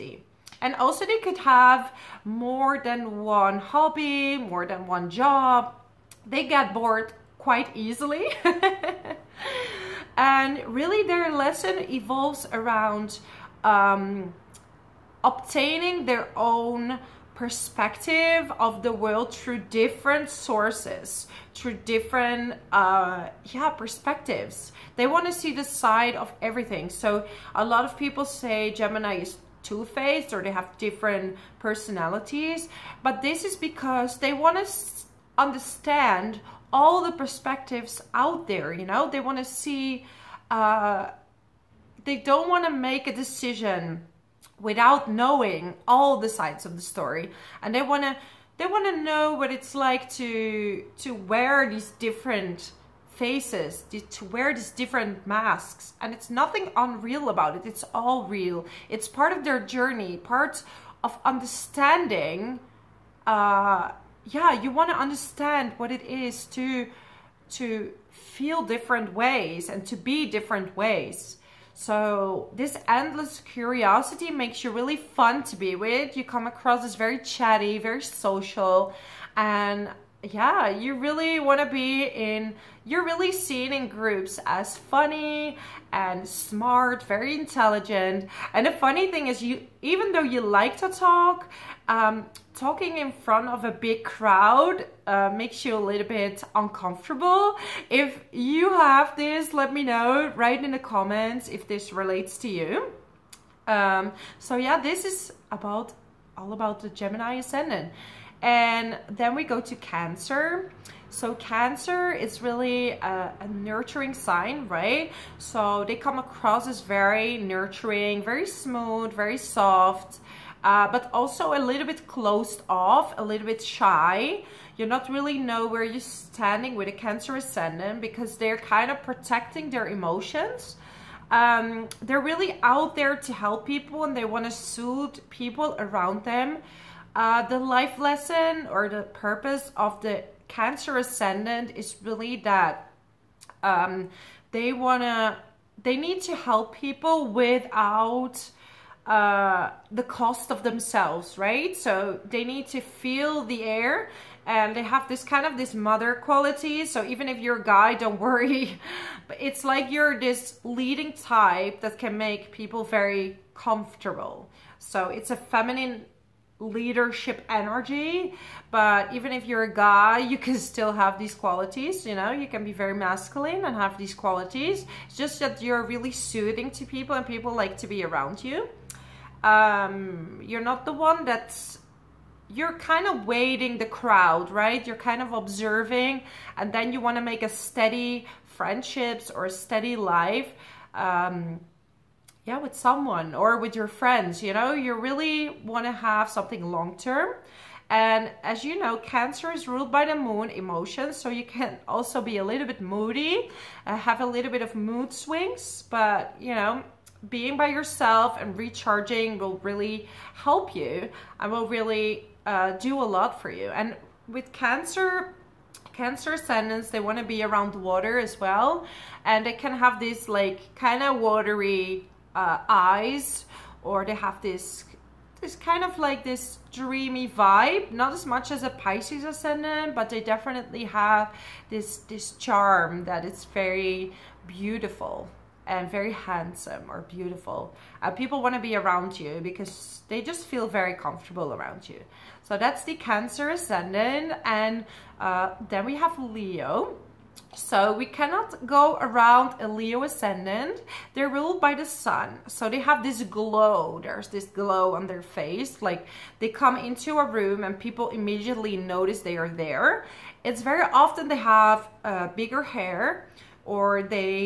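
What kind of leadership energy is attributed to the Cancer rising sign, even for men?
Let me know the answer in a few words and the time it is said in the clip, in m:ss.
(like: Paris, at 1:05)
feminine leadership energy, at 2:45.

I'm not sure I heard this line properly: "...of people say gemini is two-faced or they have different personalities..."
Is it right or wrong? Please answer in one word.
right.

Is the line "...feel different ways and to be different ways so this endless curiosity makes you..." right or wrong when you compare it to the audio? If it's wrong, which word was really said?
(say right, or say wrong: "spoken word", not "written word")
right.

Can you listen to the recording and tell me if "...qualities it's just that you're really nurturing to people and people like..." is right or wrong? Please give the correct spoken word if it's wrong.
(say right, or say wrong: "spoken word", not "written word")
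wrong: "soothing", not "nurturing".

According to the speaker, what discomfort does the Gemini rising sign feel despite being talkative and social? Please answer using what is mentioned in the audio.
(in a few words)
talking in front of a big crowd.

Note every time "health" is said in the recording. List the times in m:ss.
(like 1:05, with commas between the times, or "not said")
not said.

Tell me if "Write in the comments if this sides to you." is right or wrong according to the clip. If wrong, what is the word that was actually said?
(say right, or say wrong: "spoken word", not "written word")
wrong: "relates", not "sides".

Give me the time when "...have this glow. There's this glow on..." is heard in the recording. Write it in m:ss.
4:12.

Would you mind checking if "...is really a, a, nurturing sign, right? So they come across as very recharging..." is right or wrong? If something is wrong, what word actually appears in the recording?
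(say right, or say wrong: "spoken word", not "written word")
wrong: "nurturing", not "recharging".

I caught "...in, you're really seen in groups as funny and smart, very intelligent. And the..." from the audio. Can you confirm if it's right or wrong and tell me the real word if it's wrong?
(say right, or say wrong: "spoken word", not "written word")
right.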